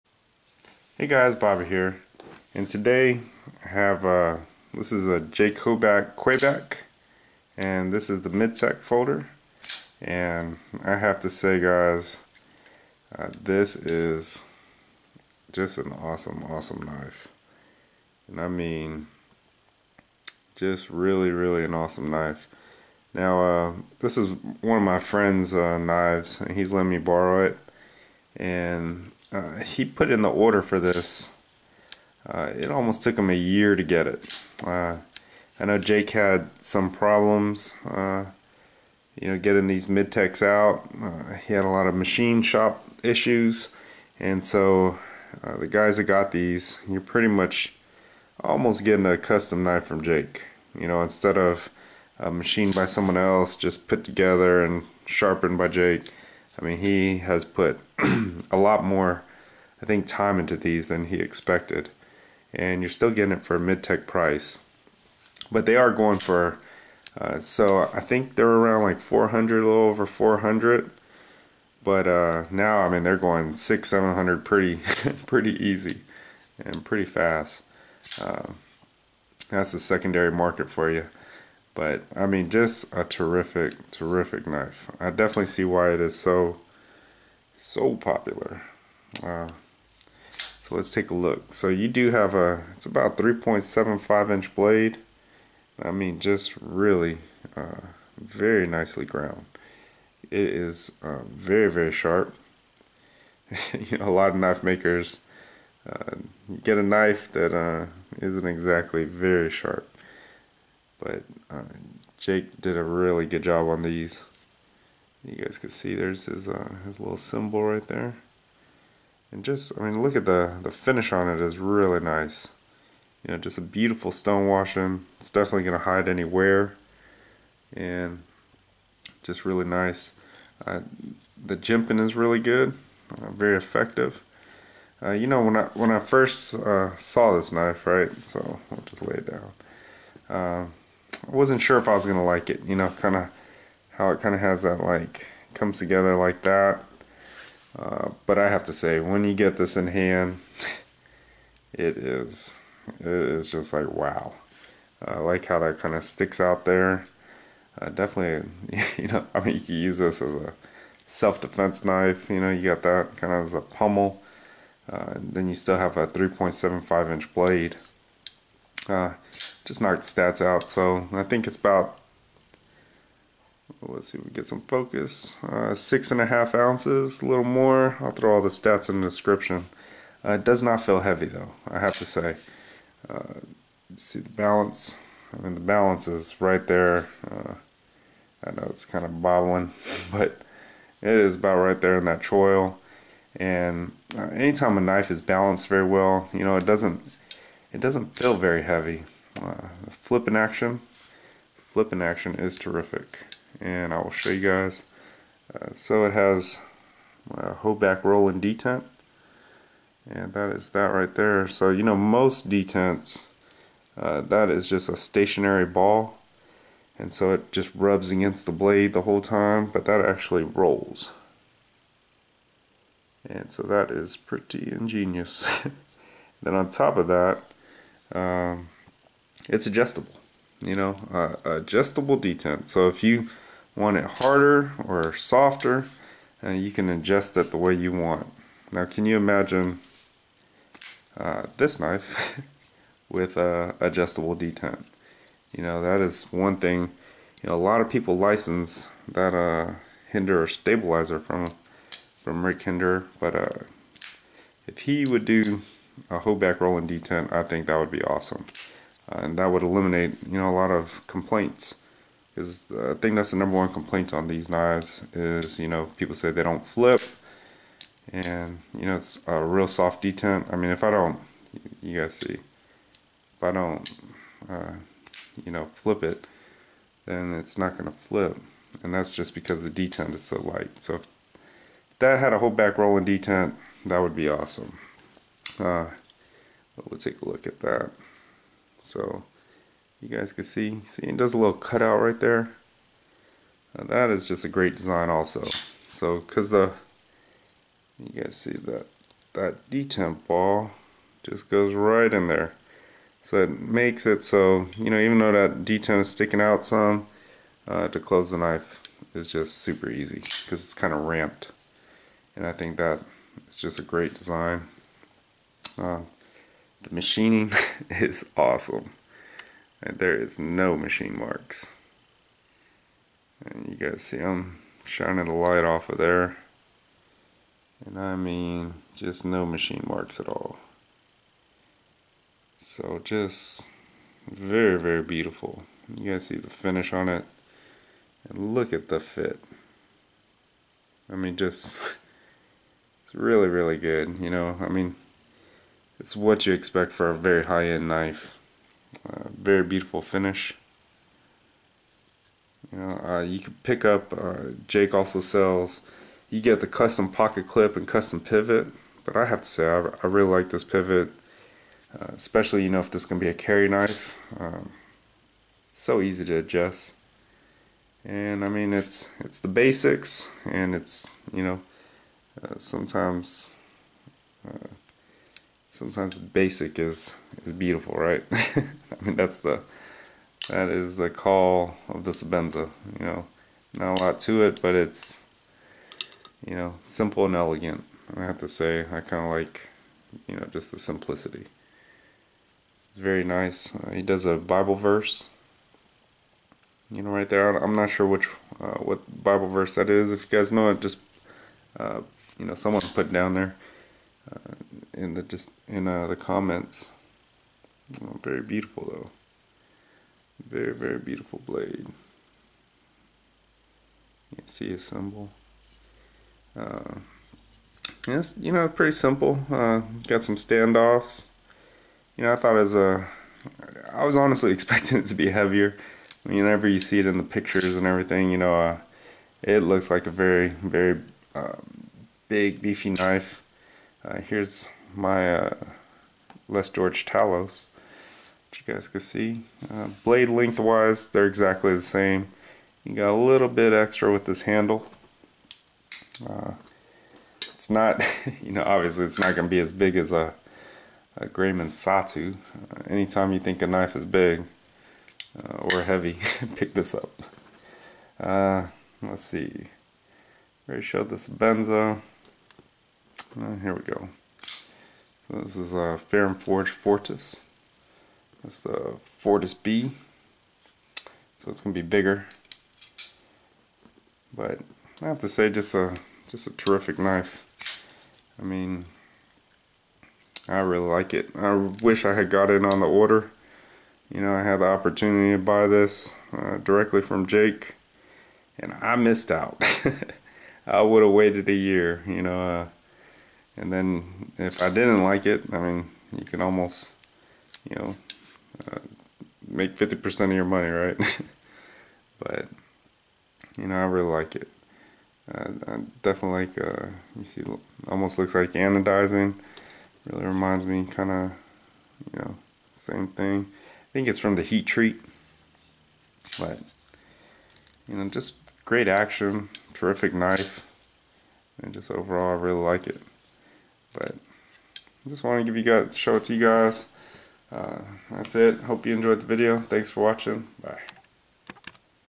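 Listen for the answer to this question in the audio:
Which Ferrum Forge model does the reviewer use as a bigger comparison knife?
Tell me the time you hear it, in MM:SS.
07:49.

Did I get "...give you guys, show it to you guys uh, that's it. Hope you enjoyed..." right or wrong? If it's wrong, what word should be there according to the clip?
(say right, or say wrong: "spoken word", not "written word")
right.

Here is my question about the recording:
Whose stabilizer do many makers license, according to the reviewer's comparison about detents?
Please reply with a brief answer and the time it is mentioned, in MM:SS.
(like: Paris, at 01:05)
Rick Hinderer, at 04:12.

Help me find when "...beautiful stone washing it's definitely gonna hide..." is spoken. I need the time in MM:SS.
02:03.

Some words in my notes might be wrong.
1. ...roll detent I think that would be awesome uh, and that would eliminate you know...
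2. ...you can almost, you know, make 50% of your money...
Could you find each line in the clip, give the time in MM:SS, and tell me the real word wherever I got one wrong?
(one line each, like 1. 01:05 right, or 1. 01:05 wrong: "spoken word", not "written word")
1. 04:16 right
2. 08:16 right.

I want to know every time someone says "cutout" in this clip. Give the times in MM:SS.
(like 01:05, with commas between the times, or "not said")
04:51.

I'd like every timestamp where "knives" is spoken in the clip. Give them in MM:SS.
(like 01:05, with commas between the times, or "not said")
00:25, 04:24.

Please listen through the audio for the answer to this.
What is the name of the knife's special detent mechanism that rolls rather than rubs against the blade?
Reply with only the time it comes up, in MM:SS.
03:27.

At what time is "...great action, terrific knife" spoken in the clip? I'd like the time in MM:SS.
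08:38.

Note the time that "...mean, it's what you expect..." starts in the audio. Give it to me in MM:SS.
05:44.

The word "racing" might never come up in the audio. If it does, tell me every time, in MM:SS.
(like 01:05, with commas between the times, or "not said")
not said.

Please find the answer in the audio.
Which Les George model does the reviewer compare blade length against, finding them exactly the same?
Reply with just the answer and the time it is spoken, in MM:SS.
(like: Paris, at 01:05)
Talos, at 07:16.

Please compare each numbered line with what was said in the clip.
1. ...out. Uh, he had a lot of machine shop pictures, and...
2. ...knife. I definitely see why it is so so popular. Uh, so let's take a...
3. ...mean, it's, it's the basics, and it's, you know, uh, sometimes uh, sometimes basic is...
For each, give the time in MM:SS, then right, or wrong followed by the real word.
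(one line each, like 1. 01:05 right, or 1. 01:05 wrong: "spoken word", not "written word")
1. 00:40 wrong: "issues", not "pictures"
2. 01:24 right
3. 06:08 right.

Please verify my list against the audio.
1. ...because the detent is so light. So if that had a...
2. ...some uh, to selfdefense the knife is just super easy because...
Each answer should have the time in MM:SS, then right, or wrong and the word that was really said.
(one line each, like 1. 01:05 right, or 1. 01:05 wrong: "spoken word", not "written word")
1. 04:39 right
2. 05:06 wrong: "close", not "selfdefense".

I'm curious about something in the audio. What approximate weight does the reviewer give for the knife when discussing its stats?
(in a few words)
6.5 ounces.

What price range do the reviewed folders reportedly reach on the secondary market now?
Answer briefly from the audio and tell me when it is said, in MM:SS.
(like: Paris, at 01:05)
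600-700, at 01:13.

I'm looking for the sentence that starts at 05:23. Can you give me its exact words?
And you guys see I'm shining the light off of there.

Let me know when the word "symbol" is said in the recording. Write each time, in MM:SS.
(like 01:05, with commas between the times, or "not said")
01:57, 06:54.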